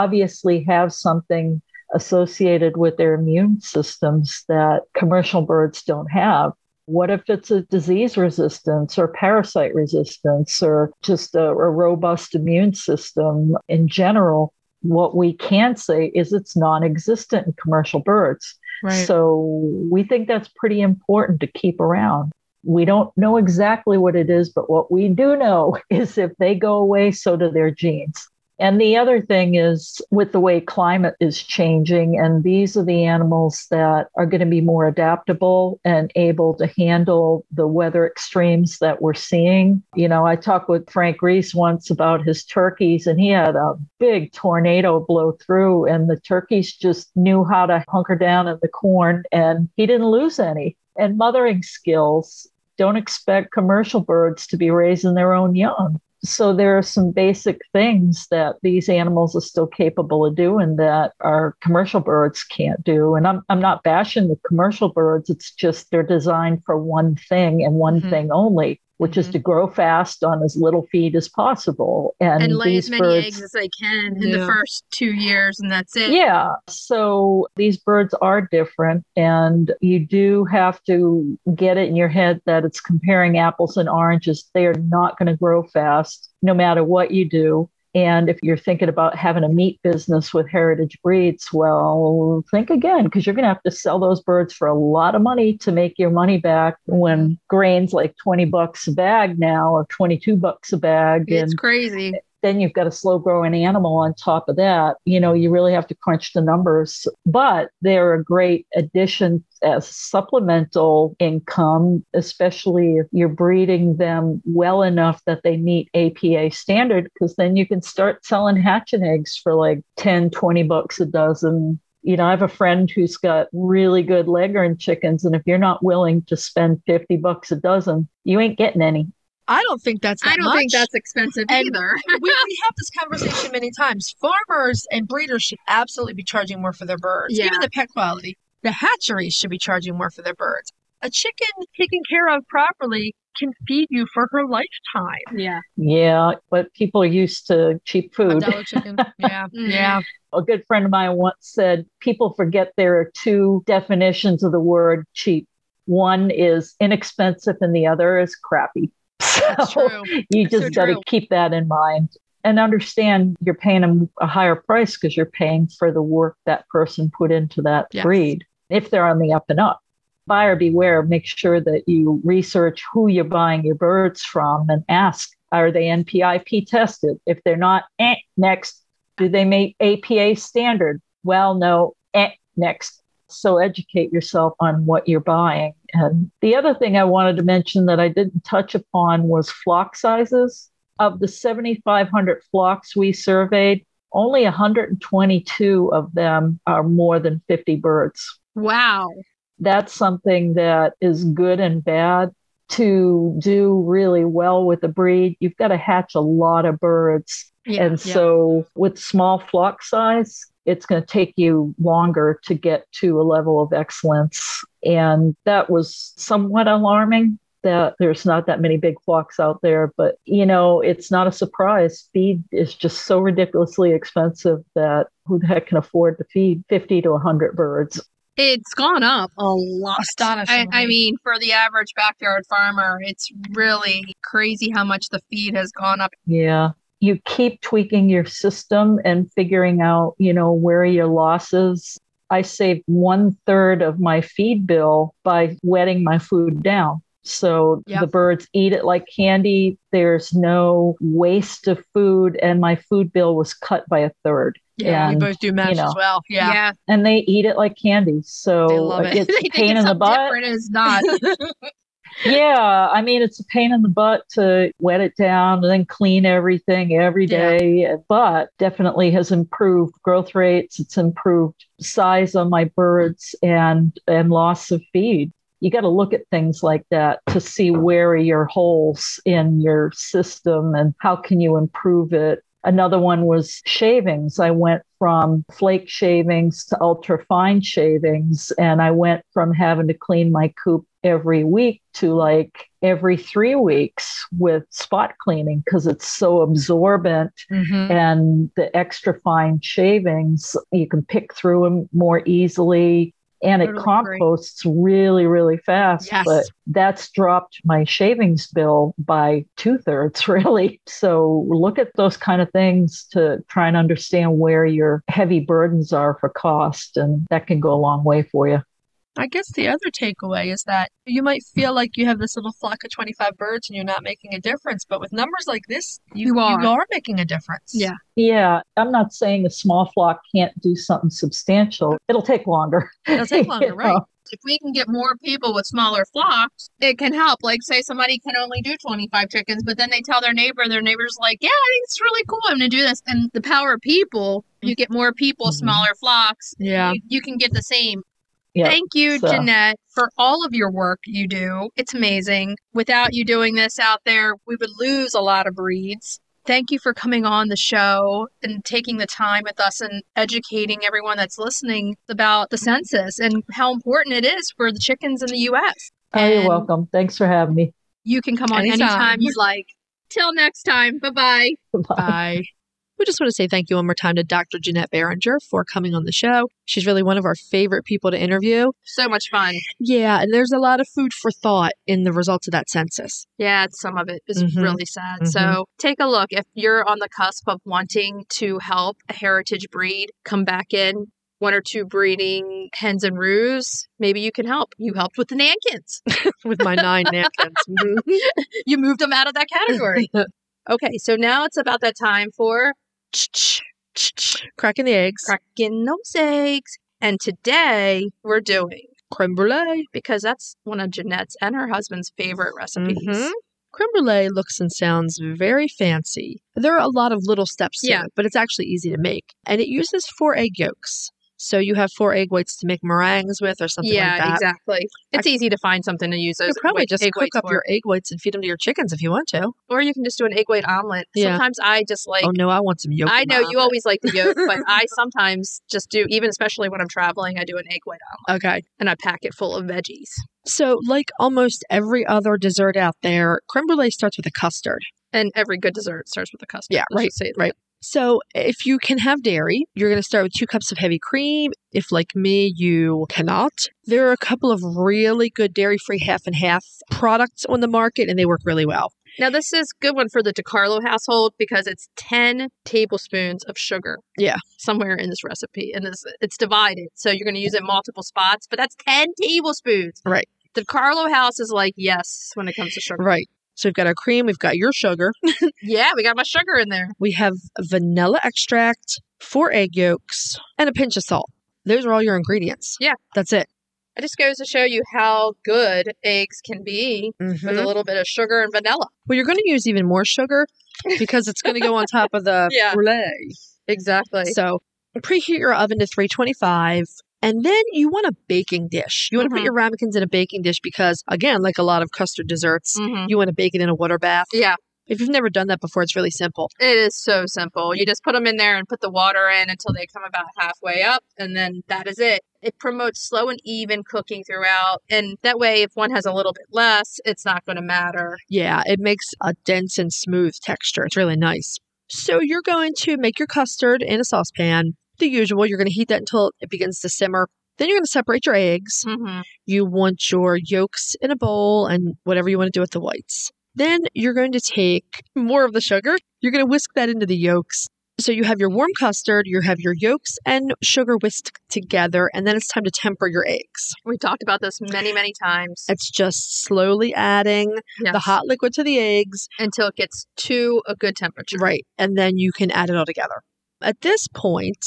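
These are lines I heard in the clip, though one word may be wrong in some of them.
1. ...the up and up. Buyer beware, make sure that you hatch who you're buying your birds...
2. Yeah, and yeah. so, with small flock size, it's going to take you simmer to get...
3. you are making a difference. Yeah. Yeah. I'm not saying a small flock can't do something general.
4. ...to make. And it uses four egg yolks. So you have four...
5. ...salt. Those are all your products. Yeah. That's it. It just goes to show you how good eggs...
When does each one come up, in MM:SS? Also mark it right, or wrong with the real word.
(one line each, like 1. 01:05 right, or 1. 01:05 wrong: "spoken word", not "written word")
1. 02:49 wrong: "research", not "hatch"
2. 03:27 wrong: "longer", not "simmer"
3. 05:26 wrong: "substantial", not "general"
4. 06:58 right
5. 08:01 wrong: "ingredients", not "products".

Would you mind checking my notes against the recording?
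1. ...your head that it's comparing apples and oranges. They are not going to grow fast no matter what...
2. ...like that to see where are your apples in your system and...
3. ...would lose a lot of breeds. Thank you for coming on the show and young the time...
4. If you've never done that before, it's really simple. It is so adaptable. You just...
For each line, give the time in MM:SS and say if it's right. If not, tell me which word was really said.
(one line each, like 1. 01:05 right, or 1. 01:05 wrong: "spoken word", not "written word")
1. 01:21 right
2. 04:36 wrong: "holes", not "apples"
3. 05:54 wrong: "taking", not "young"
4. 08:24 wrong: "simple", not "adaptable".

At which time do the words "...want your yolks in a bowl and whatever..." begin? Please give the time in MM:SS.
08:49.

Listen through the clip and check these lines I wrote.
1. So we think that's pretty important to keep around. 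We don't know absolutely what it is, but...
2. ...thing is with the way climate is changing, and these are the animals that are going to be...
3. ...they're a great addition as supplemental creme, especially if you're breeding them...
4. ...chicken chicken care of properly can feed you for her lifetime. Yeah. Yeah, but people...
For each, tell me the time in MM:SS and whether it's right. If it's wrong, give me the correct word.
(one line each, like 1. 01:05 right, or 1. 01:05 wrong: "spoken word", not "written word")
1. 00:19 wrong: "exactly", not "absolutely"
2. 00:29 right
3. 01:47 wrong: "income", not "creme"
4. 02:21 wrong: "taken", not "chicken".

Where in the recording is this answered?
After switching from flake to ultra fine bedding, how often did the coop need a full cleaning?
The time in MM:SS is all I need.
04:52.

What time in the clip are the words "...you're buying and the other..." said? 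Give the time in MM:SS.
03:05.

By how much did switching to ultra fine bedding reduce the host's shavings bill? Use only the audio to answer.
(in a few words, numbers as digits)
two thirds.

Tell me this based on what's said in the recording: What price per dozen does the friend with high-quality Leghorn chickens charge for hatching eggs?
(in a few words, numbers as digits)
$50.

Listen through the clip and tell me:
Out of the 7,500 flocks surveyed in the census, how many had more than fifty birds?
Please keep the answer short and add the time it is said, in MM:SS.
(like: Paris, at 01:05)
122, at 03:14.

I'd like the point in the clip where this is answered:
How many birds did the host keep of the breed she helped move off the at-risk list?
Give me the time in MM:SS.
06:36.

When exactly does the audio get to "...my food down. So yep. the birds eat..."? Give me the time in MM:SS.
04:06.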